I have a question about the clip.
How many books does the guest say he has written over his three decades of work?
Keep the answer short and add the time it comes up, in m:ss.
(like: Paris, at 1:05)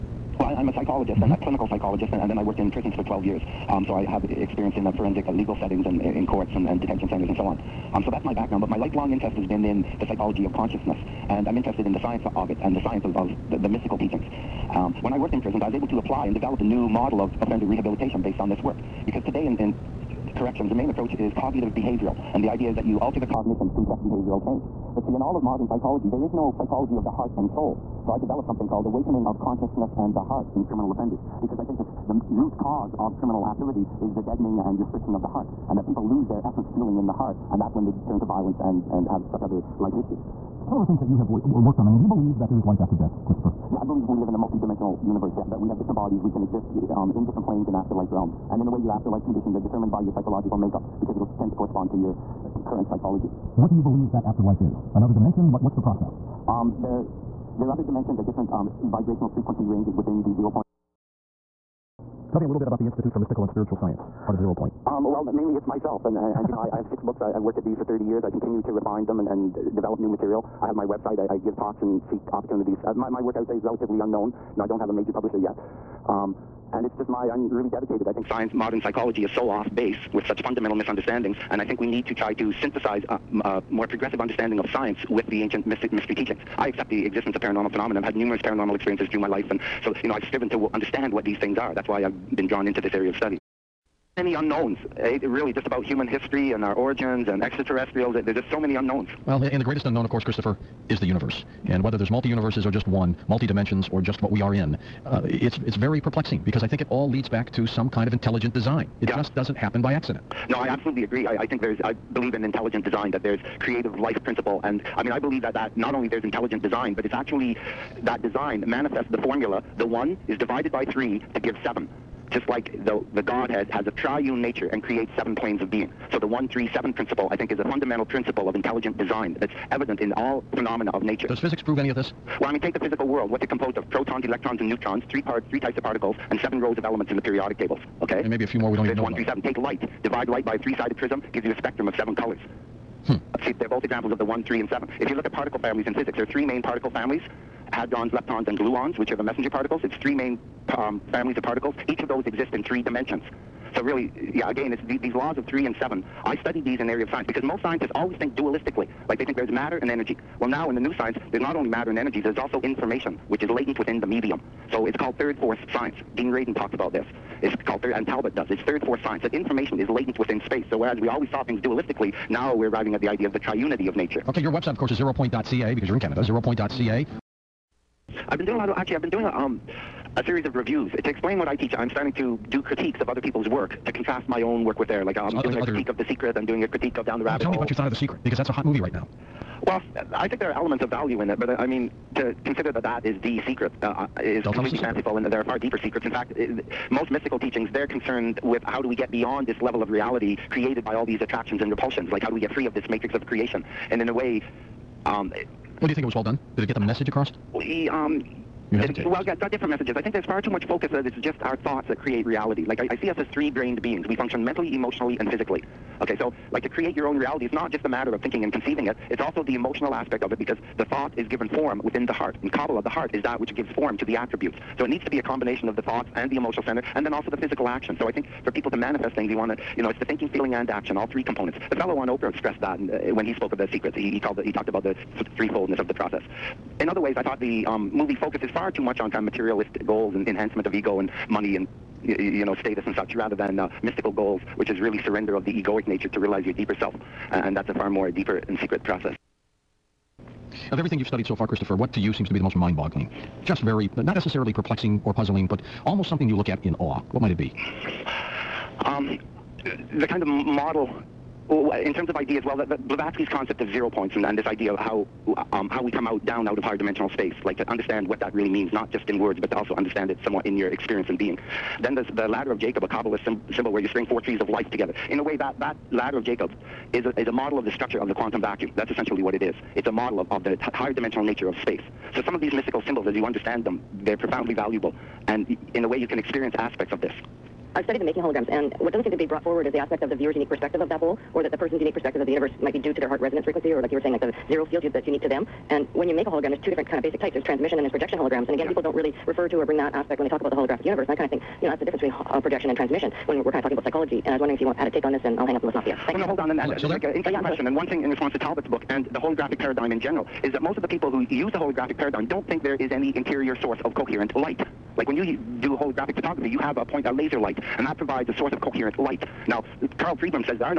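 6, at 1:06.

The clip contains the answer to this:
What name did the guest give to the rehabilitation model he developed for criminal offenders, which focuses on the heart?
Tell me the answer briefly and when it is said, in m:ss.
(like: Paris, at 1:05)
Awakening of Consciousness and the Heart, at 0:28.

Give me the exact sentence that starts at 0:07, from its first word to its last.
Um, so that's my background, but my lifelong interest has been in the psychology of consciousness.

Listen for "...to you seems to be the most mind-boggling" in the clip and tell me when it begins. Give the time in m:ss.
4:11.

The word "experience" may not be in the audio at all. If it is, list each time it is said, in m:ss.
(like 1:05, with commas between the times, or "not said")
0:04, 1:28, 4:30, 4:46.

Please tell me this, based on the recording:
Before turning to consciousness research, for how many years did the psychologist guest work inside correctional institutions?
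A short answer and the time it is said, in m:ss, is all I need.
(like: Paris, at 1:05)
12 years, at 0:03.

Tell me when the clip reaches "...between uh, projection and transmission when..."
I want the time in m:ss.
5:01.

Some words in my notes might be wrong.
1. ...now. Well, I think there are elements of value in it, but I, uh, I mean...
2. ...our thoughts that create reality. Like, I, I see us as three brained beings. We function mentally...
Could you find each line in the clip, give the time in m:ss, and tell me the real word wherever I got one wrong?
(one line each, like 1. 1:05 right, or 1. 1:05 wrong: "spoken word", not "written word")
1. 3:08 right
2. 3:31 right.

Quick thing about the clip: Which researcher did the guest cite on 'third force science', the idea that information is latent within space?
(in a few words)
Dean Radin.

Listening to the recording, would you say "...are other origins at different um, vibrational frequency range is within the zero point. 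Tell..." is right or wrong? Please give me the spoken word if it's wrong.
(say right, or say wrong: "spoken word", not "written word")
wrong: "dimensions", not "origins".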